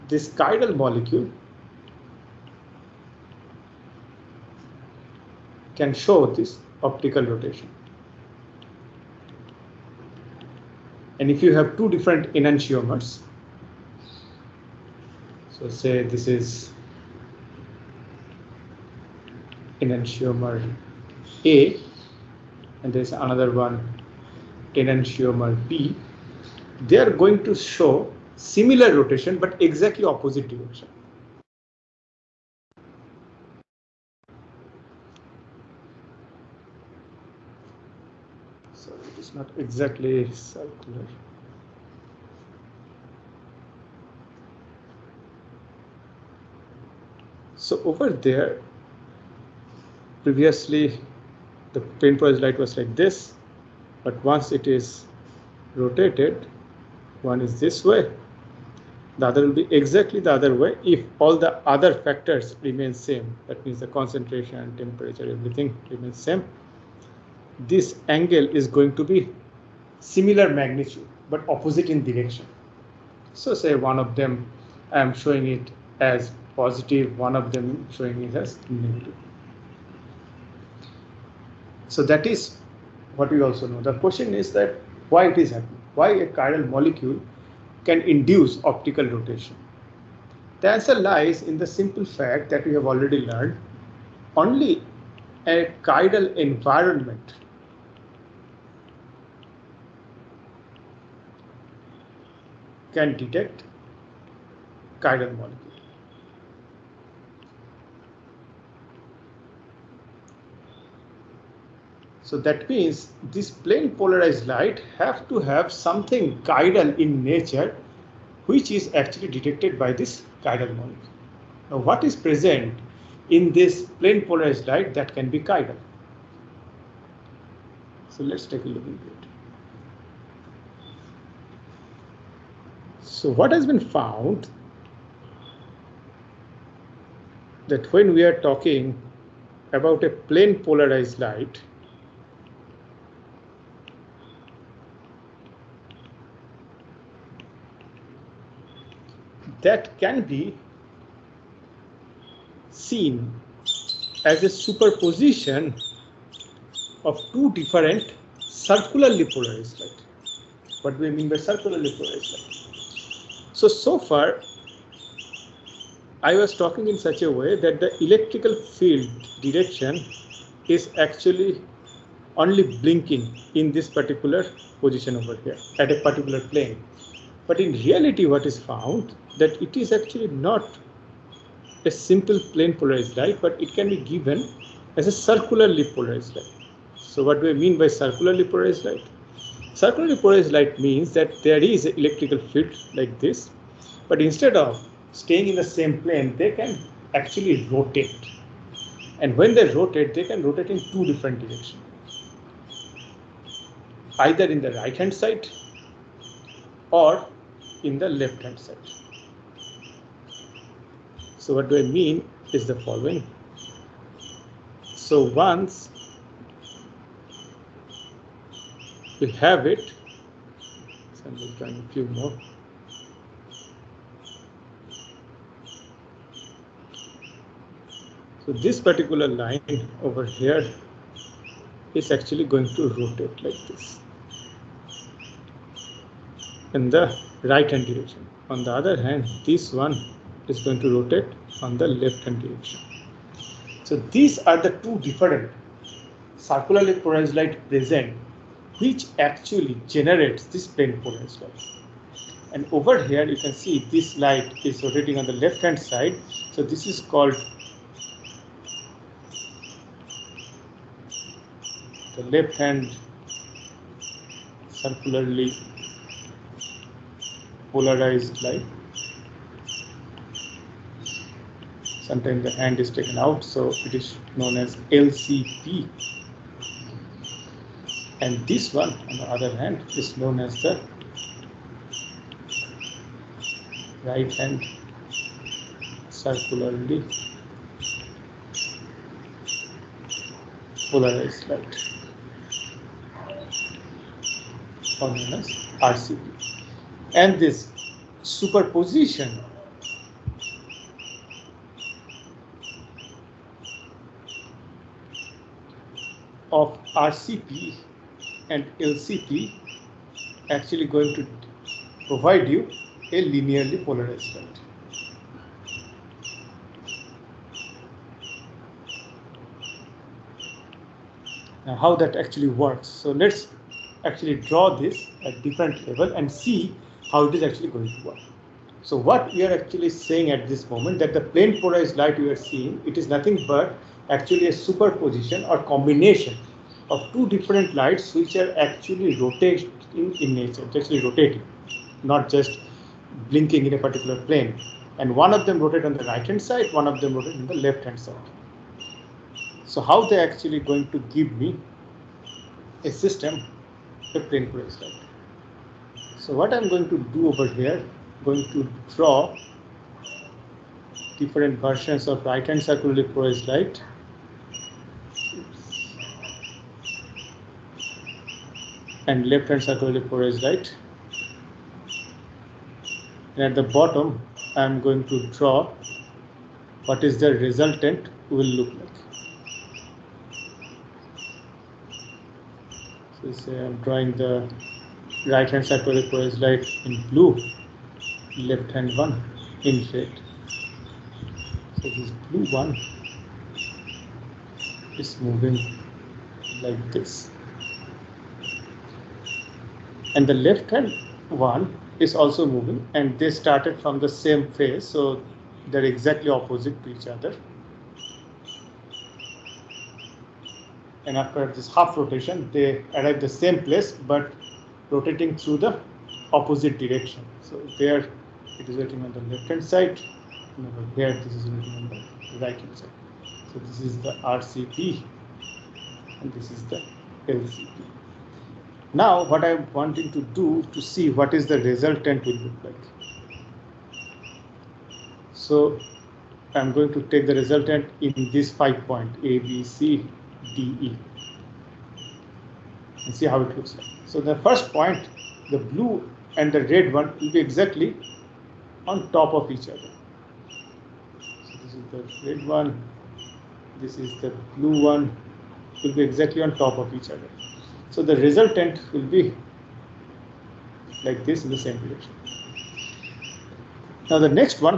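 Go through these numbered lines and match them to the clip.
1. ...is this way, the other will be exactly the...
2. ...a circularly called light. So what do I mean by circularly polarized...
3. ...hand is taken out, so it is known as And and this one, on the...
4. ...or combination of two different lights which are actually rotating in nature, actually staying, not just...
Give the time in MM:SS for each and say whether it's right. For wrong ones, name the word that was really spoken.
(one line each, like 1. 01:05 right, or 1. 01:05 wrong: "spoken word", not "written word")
1. 00:57 right
2. 03:05 wrong: "polarized", not "called"
3. 04:32 wrong: "LCP", not "And"
4. 05:35 wrong: "rotating", not "staying".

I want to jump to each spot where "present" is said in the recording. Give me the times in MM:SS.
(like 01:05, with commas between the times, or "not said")
02:02, 04:07.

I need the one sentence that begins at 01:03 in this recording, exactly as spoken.
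That means the concentration, temperature, everything remains same this angle is going to be similar magnitude but opposite in direction.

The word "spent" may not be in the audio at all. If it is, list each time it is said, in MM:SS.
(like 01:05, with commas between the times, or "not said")
not said.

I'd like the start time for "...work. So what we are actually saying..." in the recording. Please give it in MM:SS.
05:28.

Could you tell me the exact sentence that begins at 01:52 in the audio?
So that means this plane polarized light have to have something chiral in nature which is actually detected by this chiral molecule.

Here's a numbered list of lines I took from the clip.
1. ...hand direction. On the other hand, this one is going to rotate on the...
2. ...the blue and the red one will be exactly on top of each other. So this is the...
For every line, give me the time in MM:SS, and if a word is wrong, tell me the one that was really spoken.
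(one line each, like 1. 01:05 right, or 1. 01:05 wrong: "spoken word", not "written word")
1. 03:57 right
2. 07:25 right.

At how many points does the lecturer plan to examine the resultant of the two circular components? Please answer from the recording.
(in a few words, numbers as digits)
5.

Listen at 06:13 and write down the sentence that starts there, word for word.
And at the bottom, I am going to draw what is the resultant will look like.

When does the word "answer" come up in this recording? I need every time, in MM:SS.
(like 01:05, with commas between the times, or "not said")
01:30.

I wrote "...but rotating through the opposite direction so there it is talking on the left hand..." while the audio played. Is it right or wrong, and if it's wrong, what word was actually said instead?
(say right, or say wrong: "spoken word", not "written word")
wrong: "rotating", not "talking".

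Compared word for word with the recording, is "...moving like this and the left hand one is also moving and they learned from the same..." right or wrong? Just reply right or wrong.
wrong.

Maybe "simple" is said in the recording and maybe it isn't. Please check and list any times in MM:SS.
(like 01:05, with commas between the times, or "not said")
01:31, 03:01.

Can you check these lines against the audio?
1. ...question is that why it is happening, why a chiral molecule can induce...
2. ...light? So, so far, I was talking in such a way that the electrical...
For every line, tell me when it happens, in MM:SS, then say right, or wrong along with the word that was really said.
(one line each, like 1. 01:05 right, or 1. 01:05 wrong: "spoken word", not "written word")
1. 01:23 right
2. 02:42 right.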